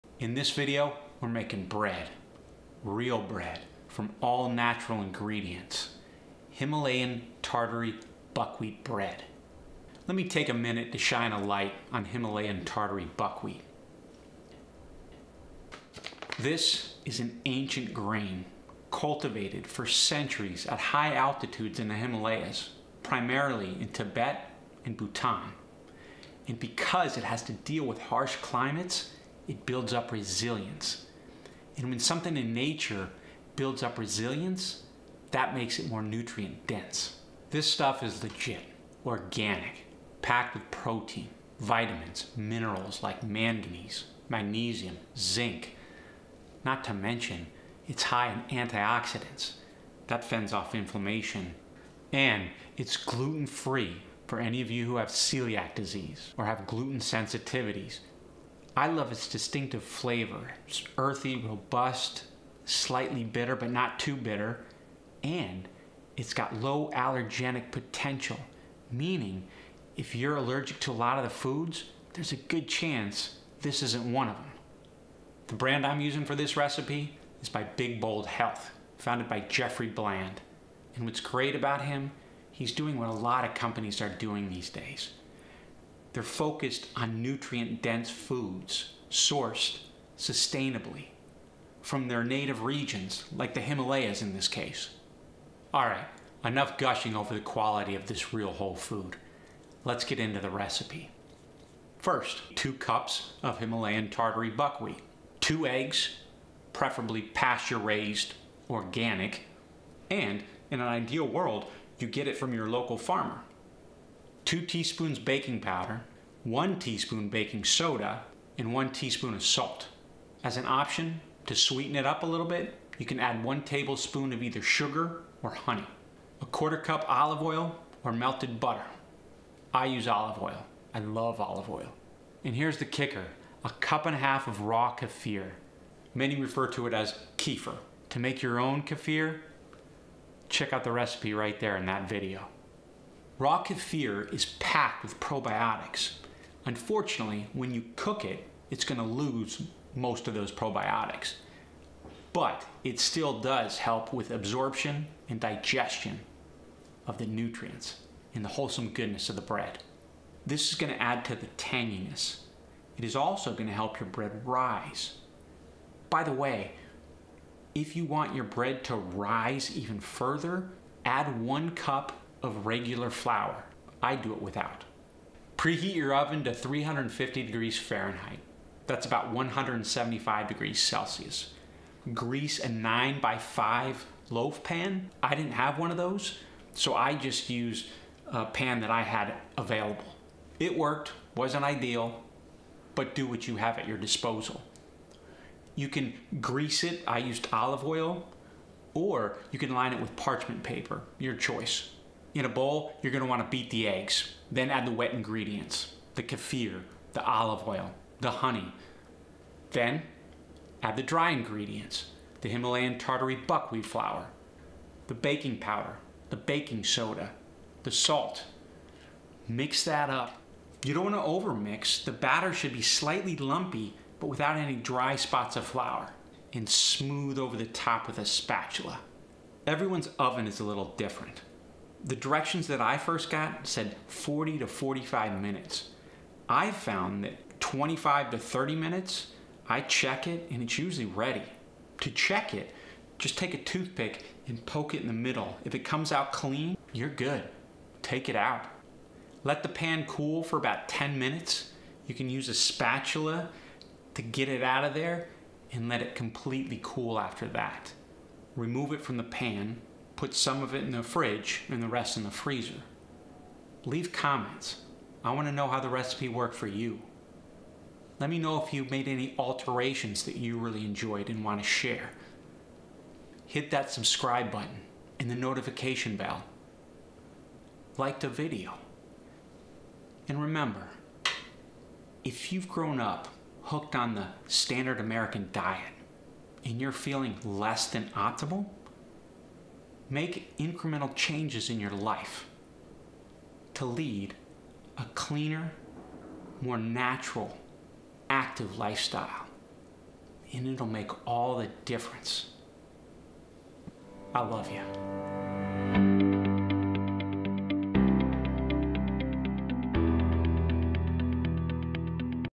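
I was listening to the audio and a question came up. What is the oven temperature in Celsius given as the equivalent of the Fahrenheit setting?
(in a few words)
175 degrees Celsius.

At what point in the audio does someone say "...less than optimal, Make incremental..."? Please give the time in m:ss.
4:47.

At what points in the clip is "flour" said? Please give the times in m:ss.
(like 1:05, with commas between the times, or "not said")
2:53, 3:33, 3:45.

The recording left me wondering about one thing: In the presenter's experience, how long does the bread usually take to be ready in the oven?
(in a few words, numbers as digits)
25 to 30 minutes.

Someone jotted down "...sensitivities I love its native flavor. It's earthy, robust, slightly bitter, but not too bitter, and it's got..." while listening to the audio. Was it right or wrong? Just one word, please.
wrong.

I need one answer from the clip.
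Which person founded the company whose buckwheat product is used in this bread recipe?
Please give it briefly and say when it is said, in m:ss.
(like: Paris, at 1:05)
Jeffrey Bland, at 1:19.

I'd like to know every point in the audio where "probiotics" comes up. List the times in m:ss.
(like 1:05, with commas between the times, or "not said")
2:25, 2:30.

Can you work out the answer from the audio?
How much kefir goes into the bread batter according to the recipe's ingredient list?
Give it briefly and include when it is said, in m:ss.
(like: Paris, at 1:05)
1.5 cups, at 2:13.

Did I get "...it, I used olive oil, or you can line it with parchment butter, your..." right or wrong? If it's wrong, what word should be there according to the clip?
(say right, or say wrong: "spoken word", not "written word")
wrong: "paper", not "butter".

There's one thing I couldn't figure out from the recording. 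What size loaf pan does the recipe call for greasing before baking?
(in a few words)
9 by 5.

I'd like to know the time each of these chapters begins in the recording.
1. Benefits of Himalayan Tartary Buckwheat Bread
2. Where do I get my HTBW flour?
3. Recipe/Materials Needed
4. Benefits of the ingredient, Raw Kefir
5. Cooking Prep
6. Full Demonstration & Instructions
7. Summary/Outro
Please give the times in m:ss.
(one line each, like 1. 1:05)
1. 0:13
2. 1:15
3. 1:42
4. 2:13
5. 2:55
6. 3:22
7. 4:23.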